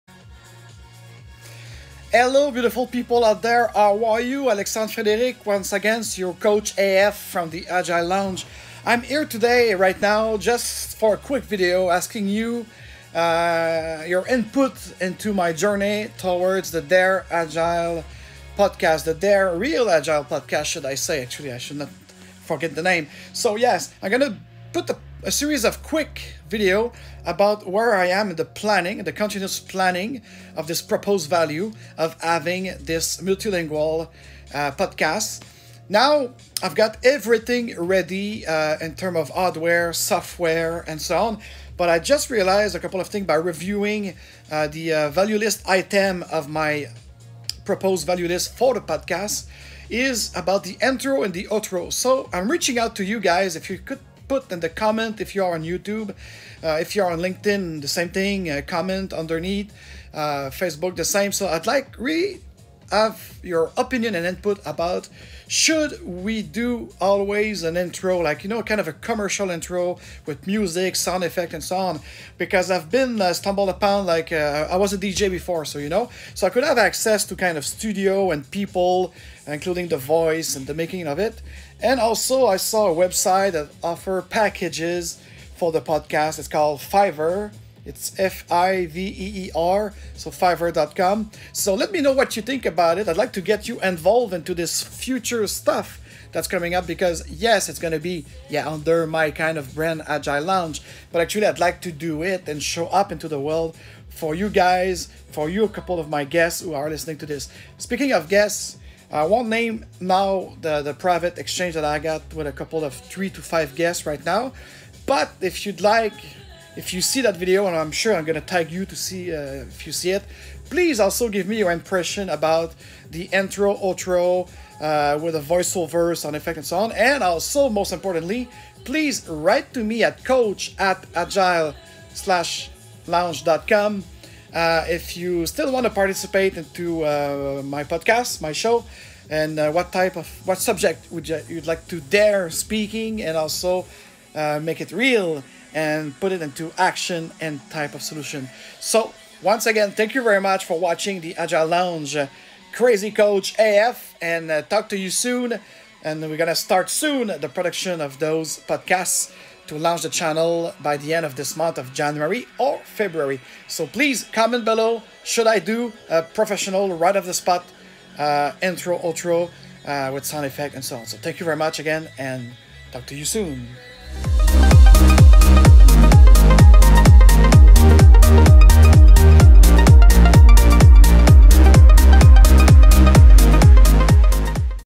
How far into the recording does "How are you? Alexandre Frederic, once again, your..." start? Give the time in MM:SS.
00:03.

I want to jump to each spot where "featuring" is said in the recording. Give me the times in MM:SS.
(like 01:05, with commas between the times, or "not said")
not said.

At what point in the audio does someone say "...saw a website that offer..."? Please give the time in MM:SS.
01:22.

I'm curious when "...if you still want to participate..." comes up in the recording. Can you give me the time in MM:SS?
02:14.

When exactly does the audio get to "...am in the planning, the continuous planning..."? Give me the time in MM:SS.
00:28.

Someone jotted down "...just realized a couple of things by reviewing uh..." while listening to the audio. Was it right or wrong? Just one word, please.
right.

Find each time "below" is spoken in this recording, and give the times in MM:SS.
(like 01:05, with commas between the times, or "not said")
02:44.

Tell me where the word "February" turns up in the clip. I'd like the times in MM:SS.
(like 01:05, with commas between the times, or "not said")
02:42.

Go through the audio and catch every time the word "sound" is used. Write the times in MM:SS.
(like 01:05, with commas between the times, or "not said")
01:10, 02:06, 02:50.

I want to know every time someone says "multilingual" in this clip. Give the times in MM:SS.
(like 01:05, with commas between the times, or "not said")
00:33.